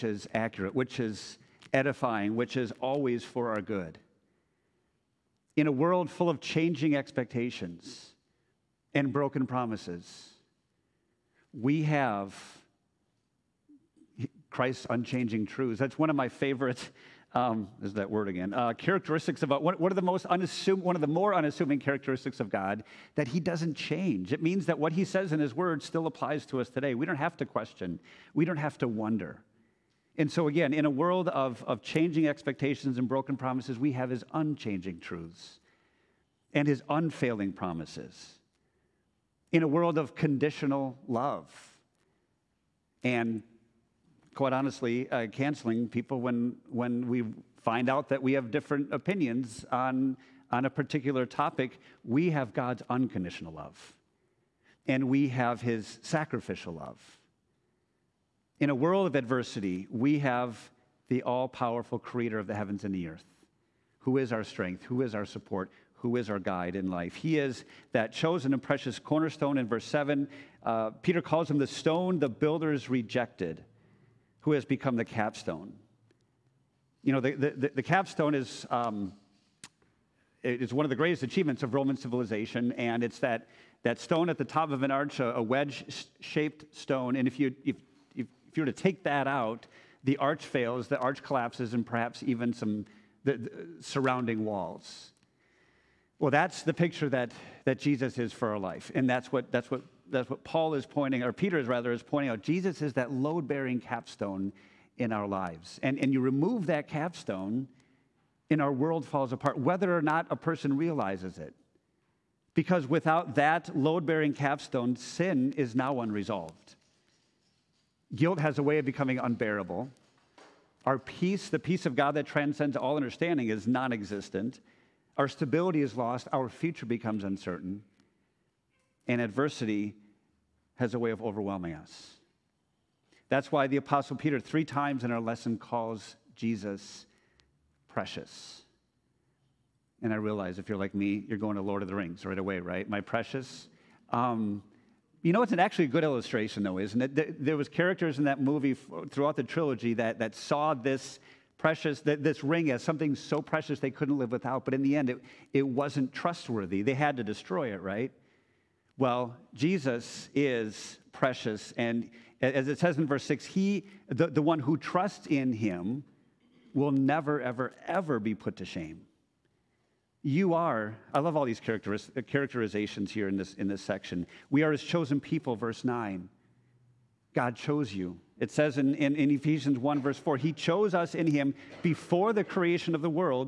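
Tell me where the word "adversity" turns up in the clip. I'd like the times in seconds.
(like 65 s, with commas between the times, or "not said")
59 s, 129 s.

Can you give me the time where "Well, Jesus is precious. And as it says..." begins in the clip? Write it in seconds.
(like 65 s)
158 s.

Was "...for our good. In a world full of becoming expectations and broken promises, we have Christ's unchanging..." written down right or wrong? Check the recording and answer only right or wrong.
wrong.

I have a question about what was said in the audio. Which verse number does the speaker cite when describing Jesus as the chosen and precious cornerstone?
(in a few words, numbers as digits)
7.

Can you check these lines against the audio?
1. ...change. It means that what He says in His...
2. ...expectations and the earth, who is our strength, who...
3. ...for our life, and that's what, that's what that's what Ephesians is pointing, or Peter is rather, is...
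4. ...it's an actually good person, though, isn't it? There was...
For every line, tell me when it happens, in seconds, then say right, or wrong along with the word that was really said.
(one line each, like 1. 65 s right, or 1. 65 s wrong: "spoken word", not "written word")
1. 23 s right
2. 62 s wrong: "heavens", not "expectations"
3. 98 s wrong: "Paul", not "Ephesians"
4. 145 s wrong: "illustration", not "person".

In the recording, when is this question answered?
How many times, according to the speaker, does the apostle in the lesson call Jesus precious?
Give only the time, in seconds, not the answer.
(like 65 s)
134 s.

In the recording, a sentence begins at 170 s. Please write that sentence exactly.
You are, I love all these uh, characterizations here in this, in this section.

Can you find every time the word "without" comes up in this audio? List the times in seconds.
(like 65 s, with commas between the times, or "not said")
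112 s, 154 s.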